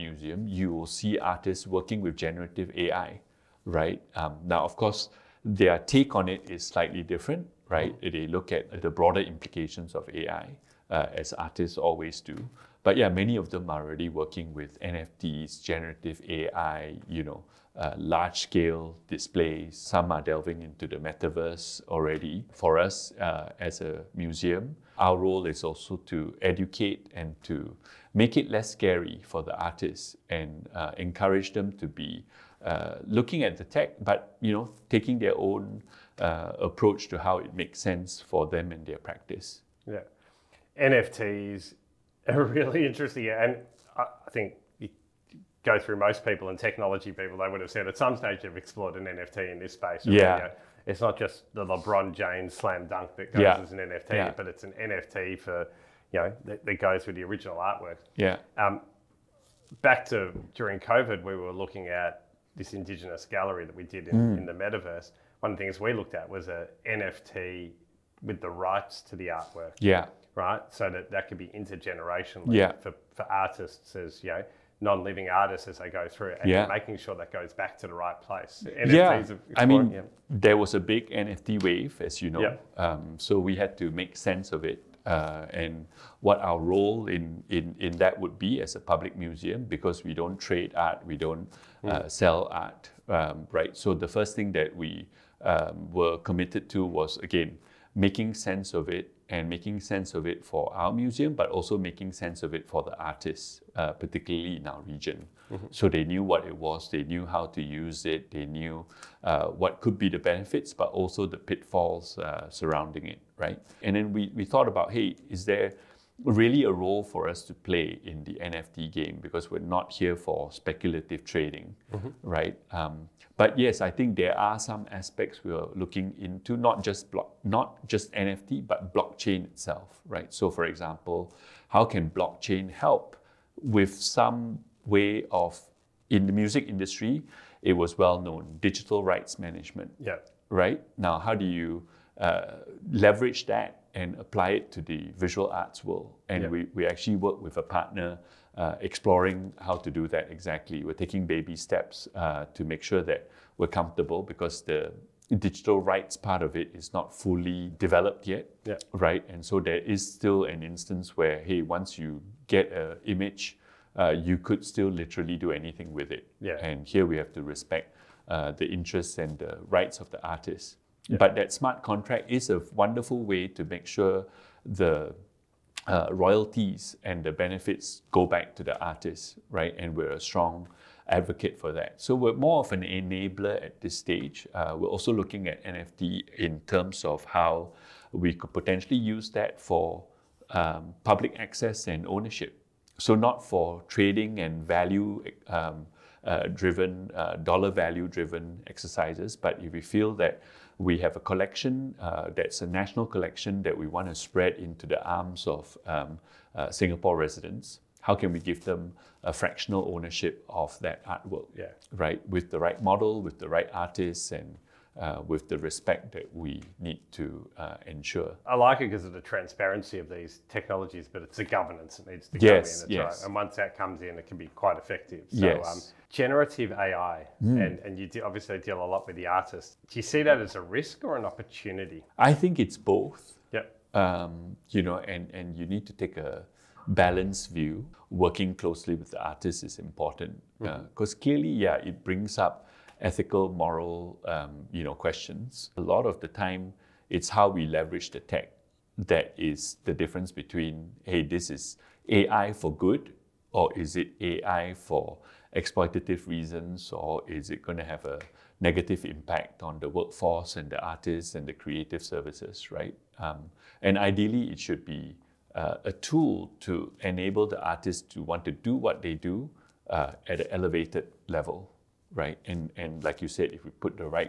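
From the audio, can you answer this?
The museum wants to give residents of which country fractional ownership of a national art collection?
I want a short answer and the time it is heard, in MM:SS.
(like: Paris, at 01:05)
Singapore, at 03:26.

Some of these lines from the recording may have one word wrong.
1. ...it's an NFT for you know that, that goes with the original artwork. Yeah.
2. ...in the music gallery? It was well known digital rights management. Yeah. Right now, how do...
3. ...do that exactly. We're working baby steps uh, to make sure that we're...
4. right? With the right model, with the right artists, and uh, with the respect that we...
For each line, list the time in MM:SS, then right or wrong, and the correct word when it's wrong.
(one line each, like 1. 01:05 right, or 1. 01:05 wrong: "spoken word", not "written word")
1. 00:54 right
2. 02:16 wrong: "industry", not "gallery"
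3. 02:29 wrong: "taking", not "working"
4. 03:31 right.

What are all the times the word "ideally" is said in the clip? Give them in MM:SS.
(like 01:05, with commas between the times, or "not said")
04:23.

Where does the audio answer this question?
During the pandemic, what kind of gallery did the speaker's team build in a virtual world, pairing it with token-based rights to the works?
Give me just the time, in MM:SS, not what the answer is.
01:02.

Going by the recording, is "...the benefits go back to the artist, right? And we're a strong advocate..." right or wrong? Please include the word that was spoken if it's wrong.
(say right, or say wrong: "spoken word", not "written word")
right.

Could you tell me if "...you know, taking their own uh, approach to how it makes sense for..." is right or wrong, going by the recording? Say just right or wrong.
right.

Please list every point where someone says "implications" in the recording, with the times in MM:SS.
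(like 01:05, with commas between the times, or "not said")
00:09.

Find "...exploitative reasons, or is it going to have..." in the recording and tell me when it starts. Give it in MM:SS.
04:15.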